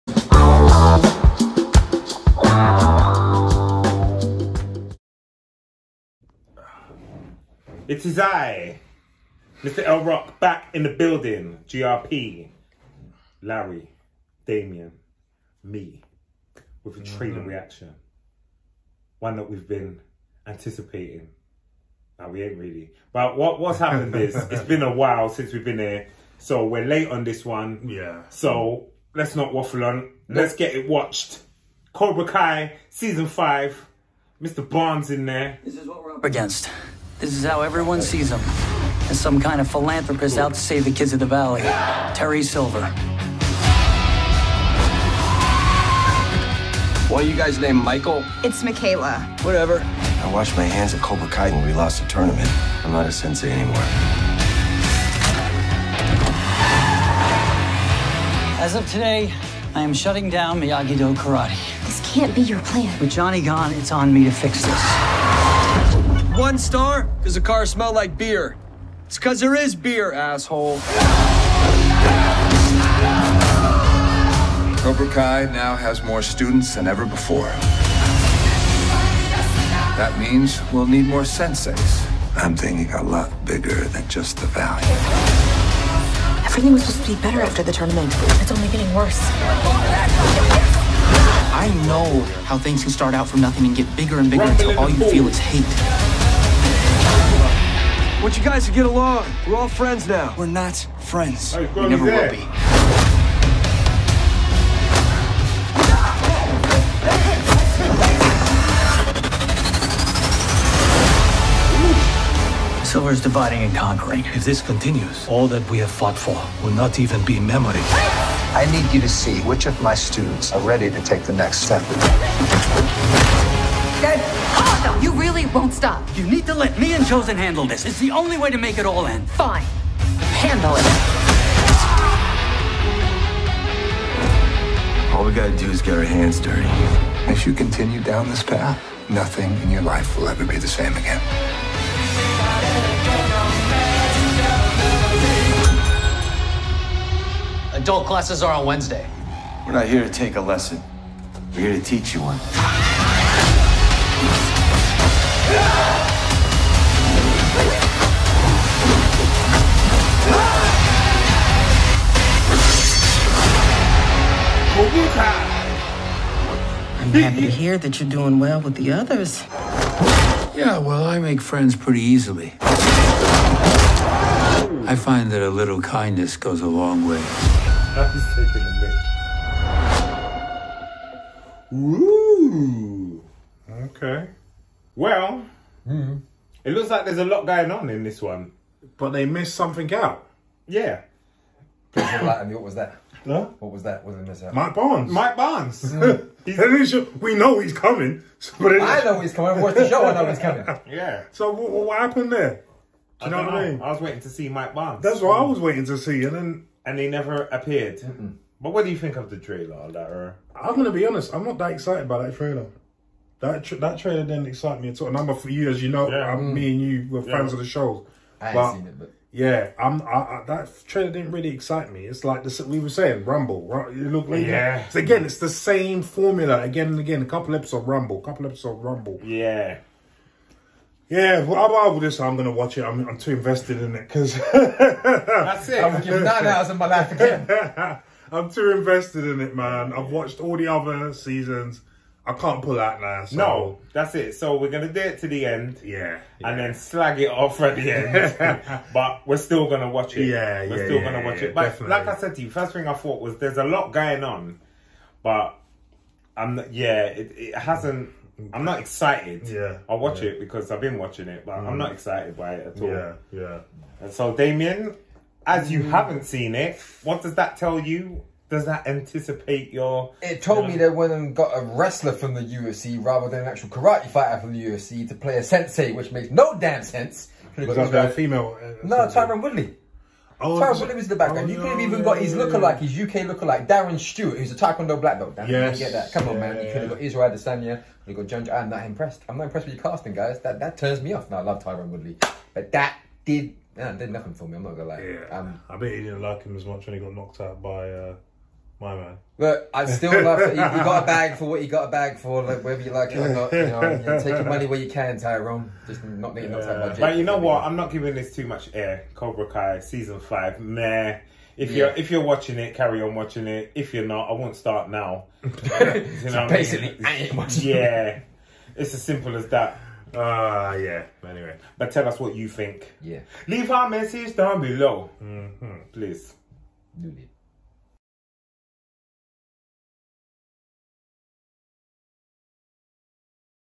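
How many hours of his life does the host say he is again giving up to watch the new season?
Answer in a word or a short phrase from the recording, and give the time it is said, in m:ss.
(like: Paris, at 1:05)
9, at 3:56.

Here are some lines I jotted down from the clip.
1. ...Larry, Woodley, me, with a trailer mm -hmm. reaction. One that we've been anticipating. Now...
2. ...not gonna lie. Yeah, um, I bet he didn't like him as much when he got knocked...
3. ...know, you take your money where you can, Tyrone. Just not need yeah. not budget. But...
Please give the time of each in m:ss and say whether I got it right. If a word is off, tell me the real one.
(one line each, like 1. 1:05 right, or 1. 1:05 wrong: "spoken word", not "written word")
1. 0:13 wrong: "Damien", not "Woodley"
2. 4:54 right
3. 5:03 right.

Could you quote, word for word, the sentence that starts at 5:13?
If you're not, I won't start now.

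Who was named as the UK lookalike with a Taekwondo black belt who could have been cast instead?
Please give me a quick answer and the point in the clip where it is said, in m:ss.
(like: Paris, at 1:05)
Darren Stewart, at 4:43.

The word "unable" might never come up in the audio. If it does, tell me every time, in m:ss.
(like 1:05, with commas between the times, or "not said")
not said.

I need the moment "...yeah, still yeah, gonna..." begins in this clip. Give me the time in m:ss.
4:10.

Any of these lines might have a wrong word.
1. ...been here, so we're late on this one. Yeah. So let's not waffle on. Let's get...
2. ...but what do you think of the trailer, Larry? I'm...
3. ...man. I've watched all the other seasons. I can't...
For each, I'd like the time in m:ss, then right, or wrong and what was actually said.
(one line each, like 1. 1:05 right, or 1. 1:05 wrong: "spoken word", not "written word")
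1. 0:25 right
2. 3:28 right
3. 3:59 right.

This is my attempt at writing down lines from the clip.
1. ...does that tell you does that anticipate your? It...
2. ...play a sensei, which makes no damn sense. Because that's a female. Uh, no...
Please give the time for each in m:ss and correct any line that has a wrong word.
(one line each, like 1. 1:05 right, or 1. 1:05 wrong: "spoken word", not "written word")
1. 4:27 right
2. 4:35 right.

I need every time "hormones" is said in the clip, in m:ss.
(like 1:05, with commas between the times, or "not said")
not said.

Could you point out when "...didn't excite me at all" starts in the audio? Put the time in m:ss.
3:34.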